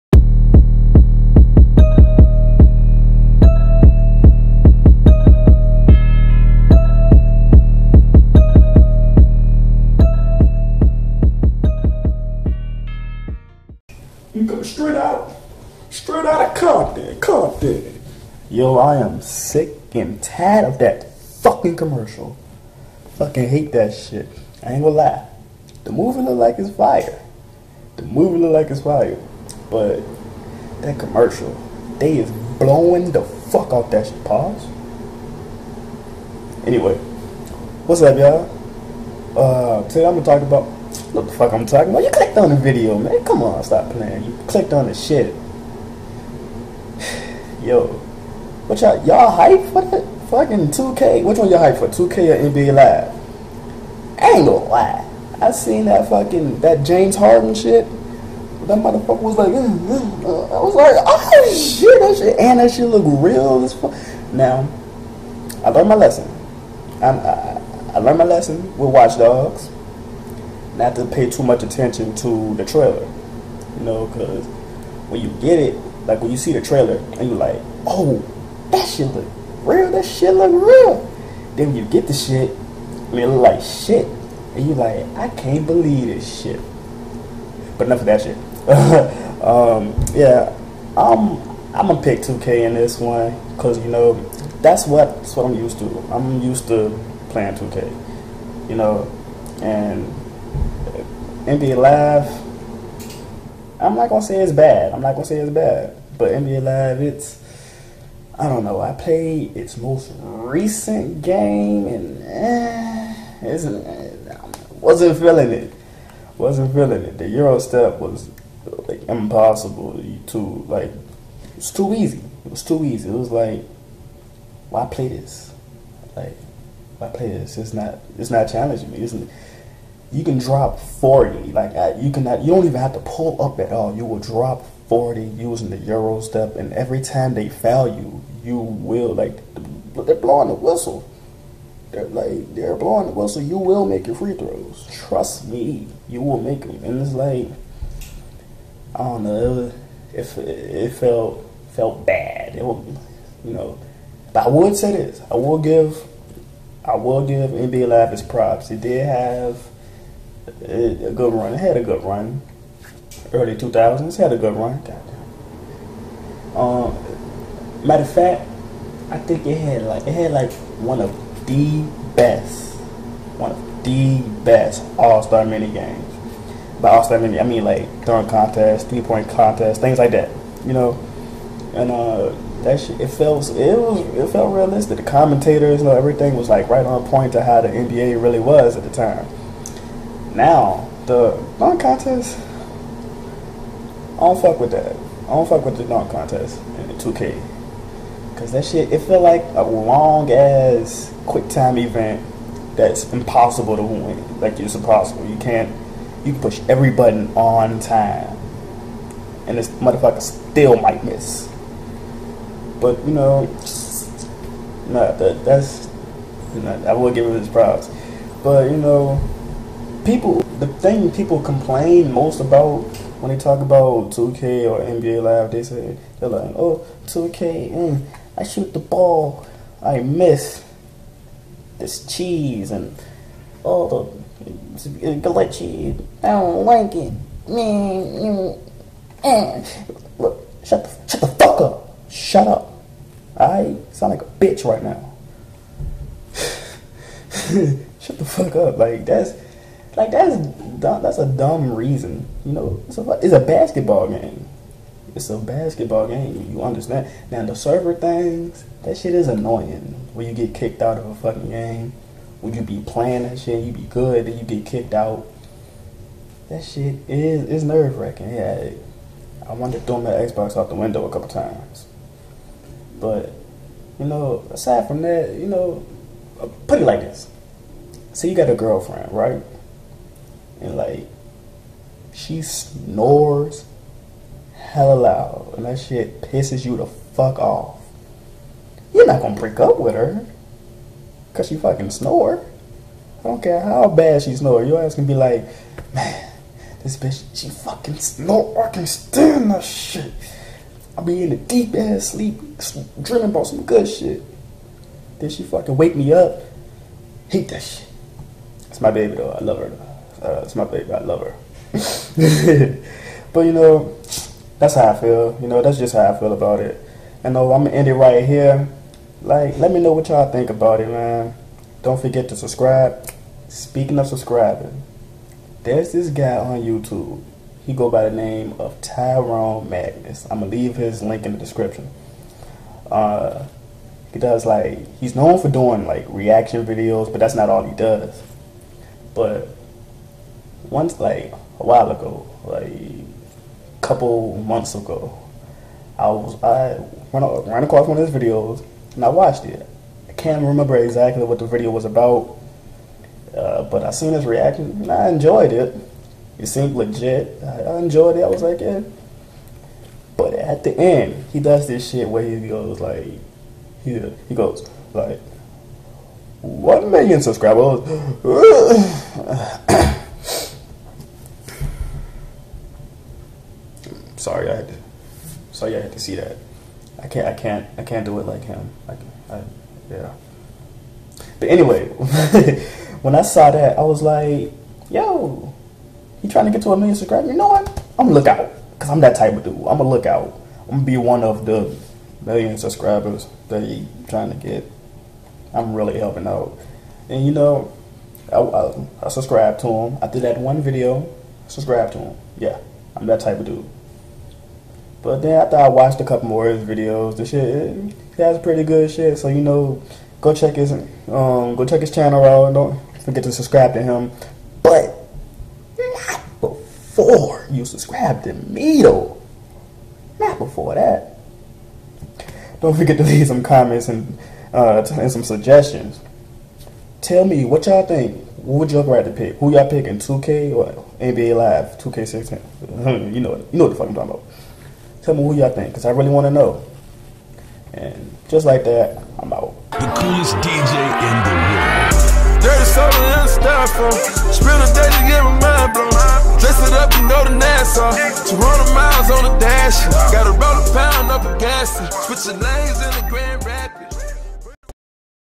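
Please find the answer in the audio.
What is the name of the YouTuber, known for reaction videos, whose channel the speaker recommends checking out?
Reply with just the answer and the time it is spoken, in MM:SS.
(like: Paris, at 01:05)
Tyrone Magnus, at 05:28.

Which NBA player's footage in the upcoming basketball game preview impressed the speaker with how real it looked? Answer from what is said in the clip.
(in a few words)
James Harden.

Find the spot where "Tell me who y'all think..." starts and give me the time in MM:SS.
07:15.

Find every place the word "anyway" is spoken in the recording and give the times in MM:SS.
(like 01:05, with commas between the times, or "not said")
00:36, 06:21.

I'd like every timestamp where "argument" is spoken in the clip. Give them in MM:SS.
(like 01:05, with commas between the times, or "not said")
not said.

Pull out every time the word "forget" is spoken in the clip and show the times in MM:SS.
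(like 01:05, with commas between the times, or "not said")
05:21, 06:53, 07:02.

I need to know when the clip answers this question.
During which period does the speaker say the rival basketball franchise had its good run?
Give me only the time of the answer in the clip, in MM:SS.
02:43.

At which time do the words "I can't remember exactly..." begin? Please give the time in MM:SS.
05:50.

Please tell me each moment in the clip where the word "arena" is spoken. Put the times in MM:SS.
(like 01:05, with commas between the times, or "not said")
not said.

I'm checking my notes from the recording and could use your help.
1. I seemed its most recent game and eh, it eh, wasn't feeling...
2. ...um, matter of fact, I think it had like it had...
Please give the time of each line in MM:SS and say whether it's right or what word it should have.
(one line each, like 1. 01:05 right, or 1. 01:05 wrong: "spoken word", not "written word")
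1. 01:48 wrong: "played", not "seemed"
2. 02:46 right.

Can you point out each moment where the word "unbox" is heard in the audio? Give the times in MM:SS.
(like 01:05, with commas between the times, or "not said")
not said.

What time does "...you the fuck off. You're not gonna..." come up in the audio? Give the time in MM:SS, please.
04:46.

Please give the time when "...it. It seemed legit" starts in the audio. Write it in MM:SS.
05:55.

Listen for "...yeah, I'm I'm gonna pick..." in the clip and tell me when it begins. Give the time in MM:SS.
01:30.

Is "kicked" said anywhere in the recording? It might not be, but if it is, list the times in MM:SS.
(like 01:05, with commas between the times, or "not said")
04:20, 04:24.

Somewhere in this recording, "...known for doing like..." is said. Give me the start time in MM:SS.
05:35.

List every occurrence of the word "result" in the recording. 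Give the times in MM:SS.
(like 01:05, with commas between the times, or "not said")
not said.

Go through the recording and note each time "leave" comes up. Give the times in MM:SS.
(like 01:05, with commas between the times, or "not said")
05:30, 07:03.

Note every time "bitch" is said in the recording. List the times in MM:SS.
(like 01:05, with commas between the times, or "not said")
04:04, 04:56.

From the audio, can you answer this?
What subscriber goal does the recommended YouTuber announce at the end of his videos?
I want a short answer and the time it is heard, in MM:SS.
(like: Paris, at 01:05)
One million, at 06:06.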